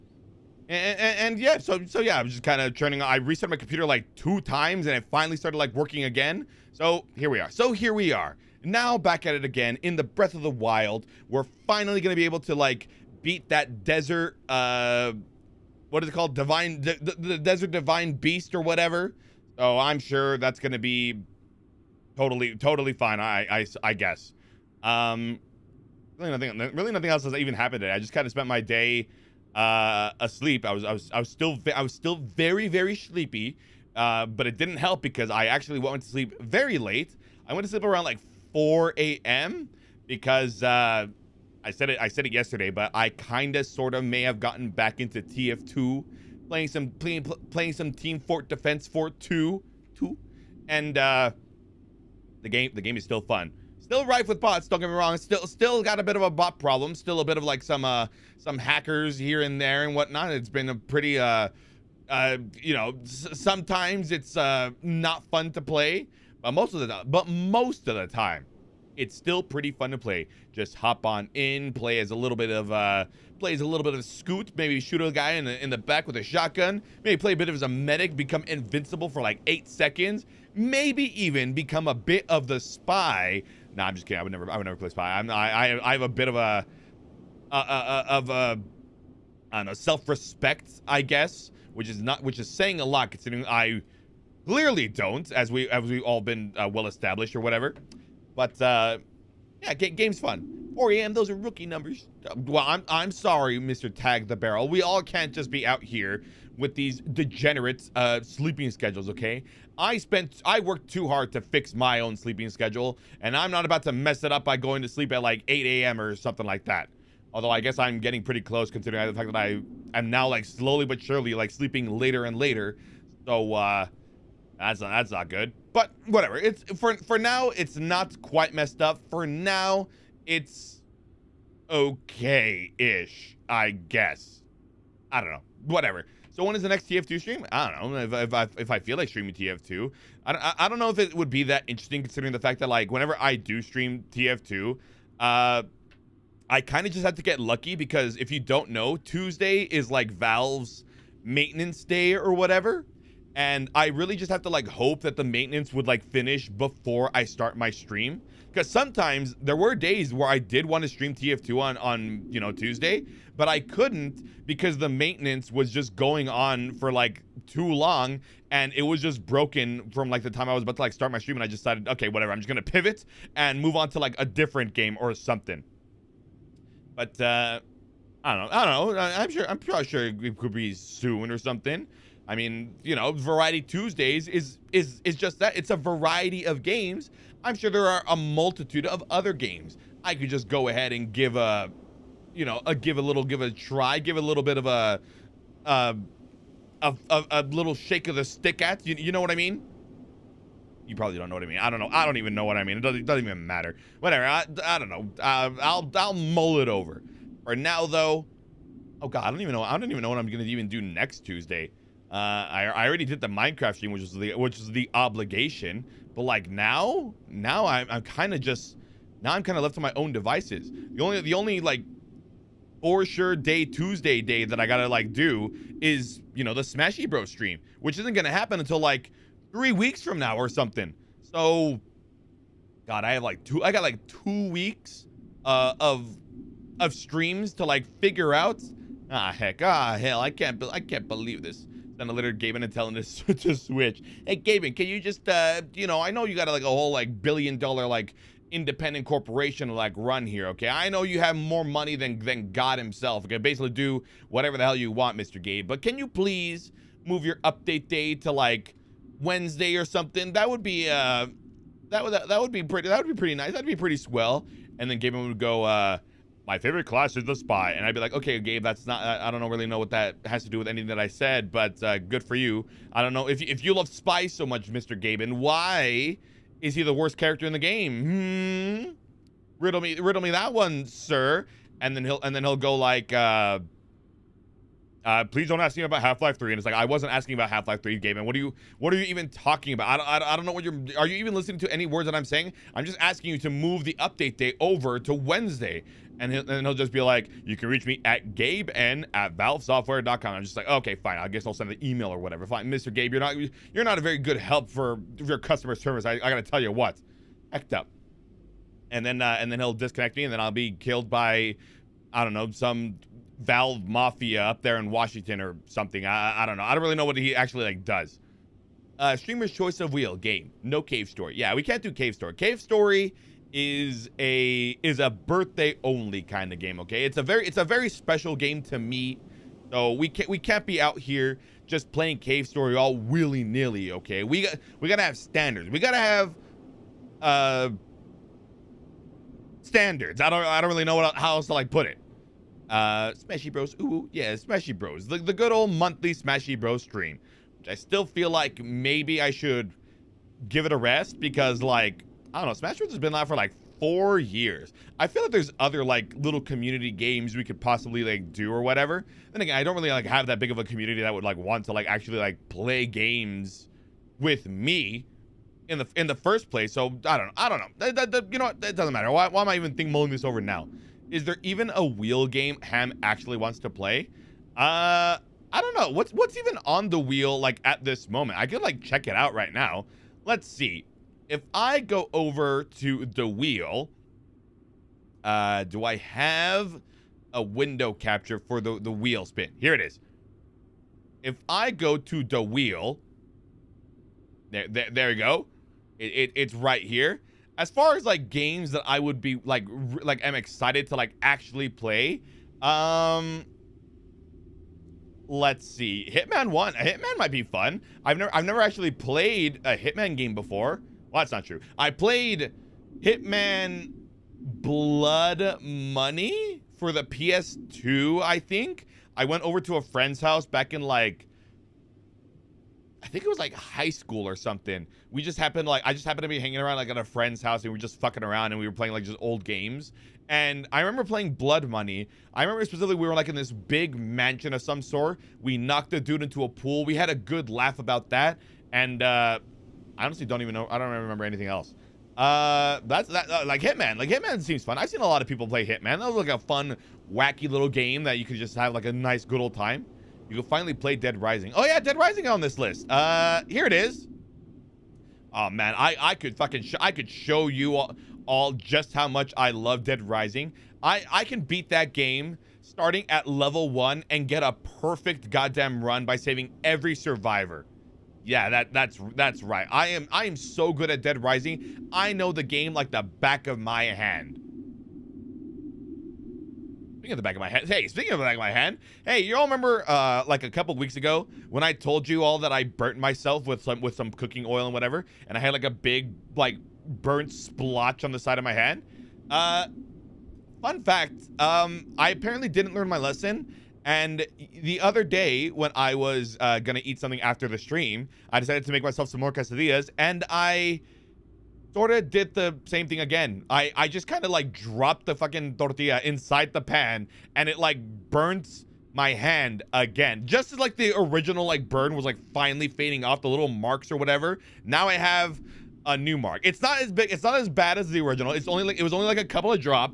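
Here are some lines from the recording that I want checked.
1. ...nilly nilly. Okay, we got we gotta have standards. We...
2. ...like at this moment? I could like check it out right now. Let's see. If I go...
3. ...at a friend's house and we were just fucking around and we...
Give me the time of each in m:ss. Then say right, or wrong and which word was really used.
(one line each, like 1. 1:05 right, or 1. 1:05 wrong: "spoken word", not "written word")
1. 5:32 wrong: "willy", not "nilly"
2. 6:17 right
3. 7:06 right.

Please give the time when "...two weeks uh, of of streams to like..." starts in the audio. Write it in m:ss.
3:54.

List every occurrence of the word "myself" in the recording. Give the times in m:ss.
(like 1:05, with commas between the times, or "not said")
8:02, 8:18.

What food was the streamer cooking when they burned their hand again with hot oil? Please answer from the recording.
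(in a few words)
Quesadillas.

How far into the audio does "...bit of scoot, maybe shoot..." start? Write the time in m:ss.
1:13.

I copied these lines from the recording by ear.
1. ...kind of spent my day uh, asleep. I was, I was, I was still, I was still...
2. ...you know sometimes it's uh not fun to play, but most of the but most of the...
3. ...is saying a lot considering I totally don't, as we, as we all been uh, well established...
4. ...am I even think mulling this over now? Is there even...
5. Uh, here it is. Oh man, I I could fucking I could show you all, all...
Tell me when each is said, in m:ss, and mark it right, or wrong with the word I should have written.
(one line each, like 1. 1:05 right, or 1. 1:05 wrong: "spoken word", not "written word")
1. 0:28 right
2. 1:02 right
3. 1:32 wrong: "clearly", not "totally"
4. 6:09 right
5. 7:32 right.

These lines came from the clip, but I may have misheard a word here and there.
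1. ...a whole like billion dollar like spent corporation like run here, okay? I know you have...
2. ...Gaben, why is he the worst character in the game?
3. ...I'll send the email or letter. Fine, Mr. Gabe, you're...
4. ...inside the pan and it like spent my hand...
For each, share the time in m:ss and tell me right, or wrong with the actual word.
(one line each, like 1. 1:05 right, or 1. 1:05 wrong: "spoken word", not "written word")
1. 4:06 wrong: "independent", not "spent"
2. 4:34 right
3. 5:01 wrong: "whatever", not "letter"
4. 8:26 wrong: "burnt", not "spent".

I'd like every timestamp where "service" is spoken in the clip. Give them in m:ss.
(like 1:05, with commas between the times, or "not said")
5:05.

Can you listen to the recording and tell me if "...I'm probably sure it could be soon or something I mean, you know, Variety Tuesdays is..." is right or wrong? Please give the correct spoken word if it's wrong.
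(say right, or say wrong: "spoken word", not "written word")
right.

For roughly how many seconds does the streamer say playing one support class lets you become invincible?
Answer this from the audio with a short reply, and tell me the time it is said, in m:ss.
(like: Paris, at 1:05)
8, at 1:19.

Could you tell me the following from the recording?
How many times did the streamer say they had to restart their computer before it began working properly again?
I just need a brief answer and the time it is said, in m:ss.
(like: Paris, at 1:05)
2, at 0:04.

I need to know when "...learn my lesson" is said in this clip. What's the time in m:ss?
8:12.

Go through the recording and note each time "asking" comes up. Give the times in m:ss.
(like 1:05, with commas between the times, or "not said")
4:47, 4:52.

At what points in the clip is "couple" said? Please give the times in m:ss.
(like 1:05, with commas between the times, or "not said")
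8:00, 8:39.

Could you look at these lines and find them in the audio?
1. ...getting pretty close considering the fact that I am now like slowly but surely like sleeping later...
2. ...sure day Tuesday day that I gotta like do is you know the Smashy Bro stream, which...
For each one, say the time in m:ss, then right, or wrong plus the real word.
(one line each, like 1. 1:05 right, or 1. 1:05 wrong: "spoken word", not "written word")
1. 1:57 right
2. 3:43 right.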